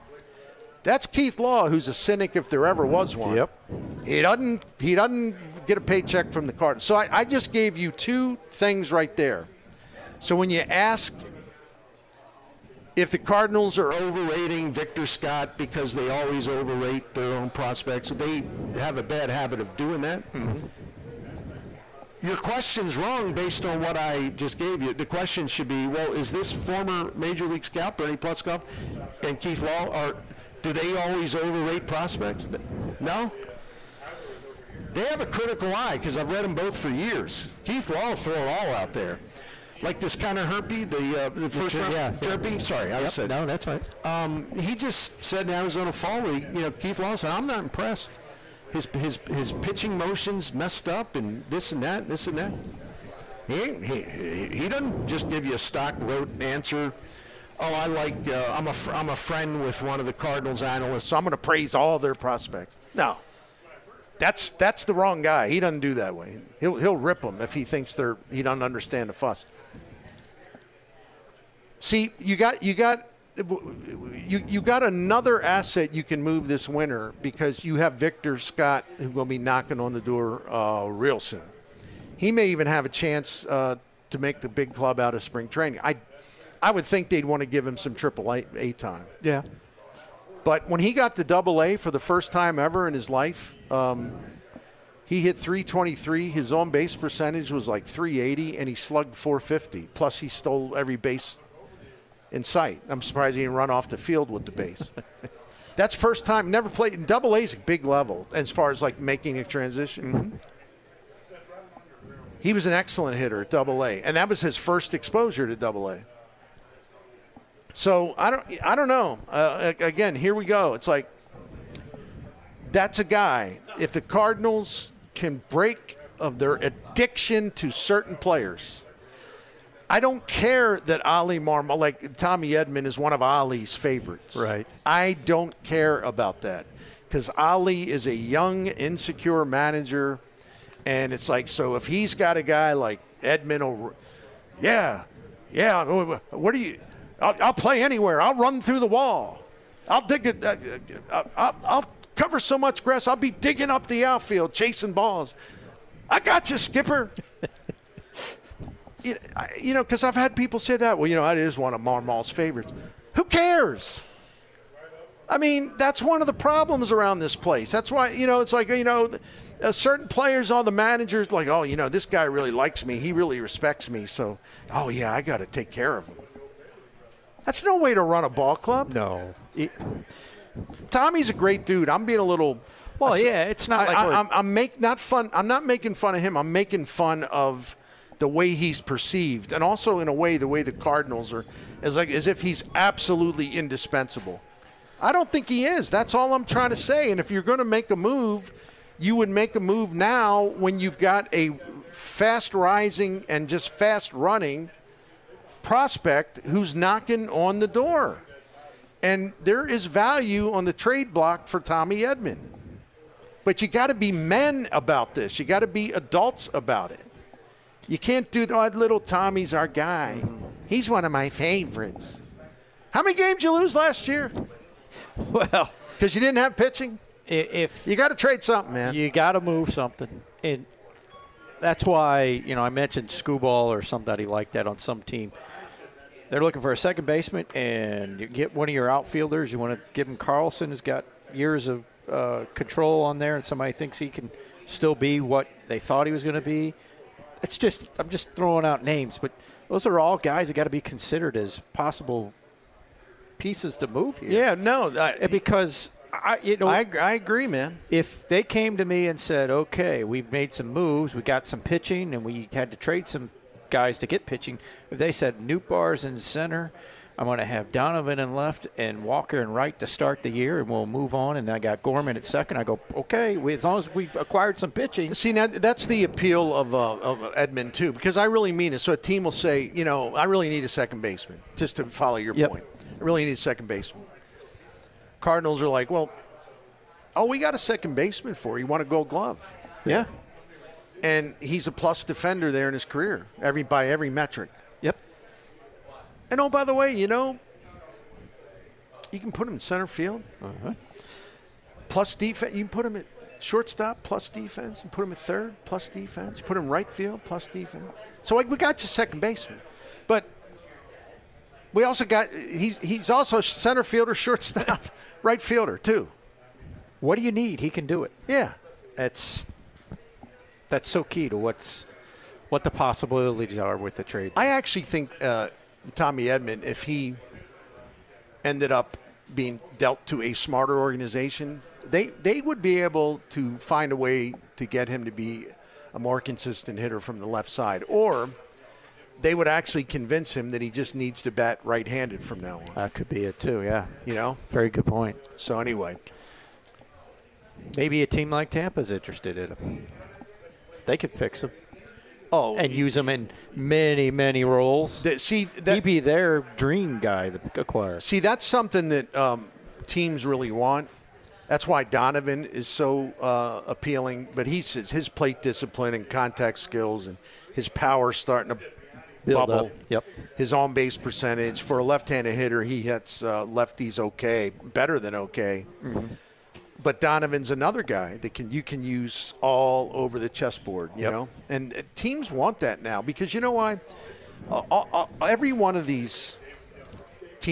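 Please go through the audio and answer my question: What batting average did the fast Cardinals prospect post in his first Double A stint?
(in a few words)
323.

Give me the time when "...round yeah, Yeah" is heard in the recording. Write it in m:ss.
0:41.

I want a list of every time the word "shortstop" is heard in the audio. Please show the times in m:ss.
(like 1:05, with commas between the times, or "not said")
5:03, 5:14.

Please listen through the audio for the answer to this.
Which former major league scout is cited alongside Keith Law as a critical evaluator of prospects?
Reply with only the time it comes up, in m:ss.
0:27.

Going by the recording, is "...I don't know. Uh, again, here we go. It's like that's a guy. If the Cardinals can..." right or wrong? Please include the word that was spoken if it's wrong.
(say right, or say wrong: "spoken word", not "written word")
right.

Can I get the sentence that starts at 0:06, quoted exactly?
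So I, I just gave you two things right there.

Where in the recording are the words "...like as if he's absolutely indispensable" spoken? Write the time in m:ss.
3:11.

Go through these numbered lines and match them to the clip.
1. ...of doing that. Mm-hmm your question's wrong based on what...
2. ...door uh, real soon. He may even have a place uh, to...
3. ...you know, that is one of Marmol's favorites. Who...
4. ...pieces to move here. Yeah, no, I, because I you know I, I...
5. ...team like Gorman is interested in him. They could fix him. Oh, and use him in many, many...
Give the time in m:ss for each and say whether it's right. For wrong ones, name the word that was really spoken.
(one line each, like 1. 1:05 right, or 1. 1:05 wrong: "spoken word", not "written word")
1. 0:19 right
2. 1:19 wrong: "chance", not "place"
3. 2:41 right
4. 4:13 right
5. 5:48 wrong: "Tampa", not "Gorman".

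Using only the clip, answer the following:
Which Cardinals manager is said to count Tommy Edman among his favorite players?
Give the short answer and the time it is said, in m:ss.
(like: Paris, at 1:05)
Oli Marmol, at 2:11.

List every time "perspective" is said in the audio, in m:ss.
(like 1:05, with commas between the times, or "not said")
not said.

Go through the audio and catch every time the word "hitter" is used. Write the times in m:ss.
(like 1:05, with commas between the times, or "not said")
1:53, 5:36, 6:12.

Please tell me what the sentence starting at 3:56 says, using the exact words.
They're looking for a second baseman, and you get one of your outfielders.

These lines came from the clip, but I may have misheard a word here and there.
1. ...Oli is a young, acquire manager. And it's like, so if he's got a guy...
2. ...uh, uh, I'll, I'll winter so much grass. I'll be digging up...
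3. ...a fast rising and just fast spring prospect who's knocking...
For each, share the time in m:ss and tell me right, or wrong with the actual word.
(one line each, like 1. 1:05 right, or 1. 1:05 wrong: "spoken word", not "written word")
1. 2:17 wrong: "insecure", not "acquire"
2. 2:30 wrong: "cover", not "winter"
3. 3:21 wrong: "running", not "spring".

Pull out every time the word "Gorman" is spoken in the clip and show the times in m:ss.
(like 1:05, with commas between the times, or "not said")
4:31.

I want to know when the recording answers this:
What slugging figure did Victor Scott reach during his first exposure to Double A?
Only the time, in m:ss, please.
1:39.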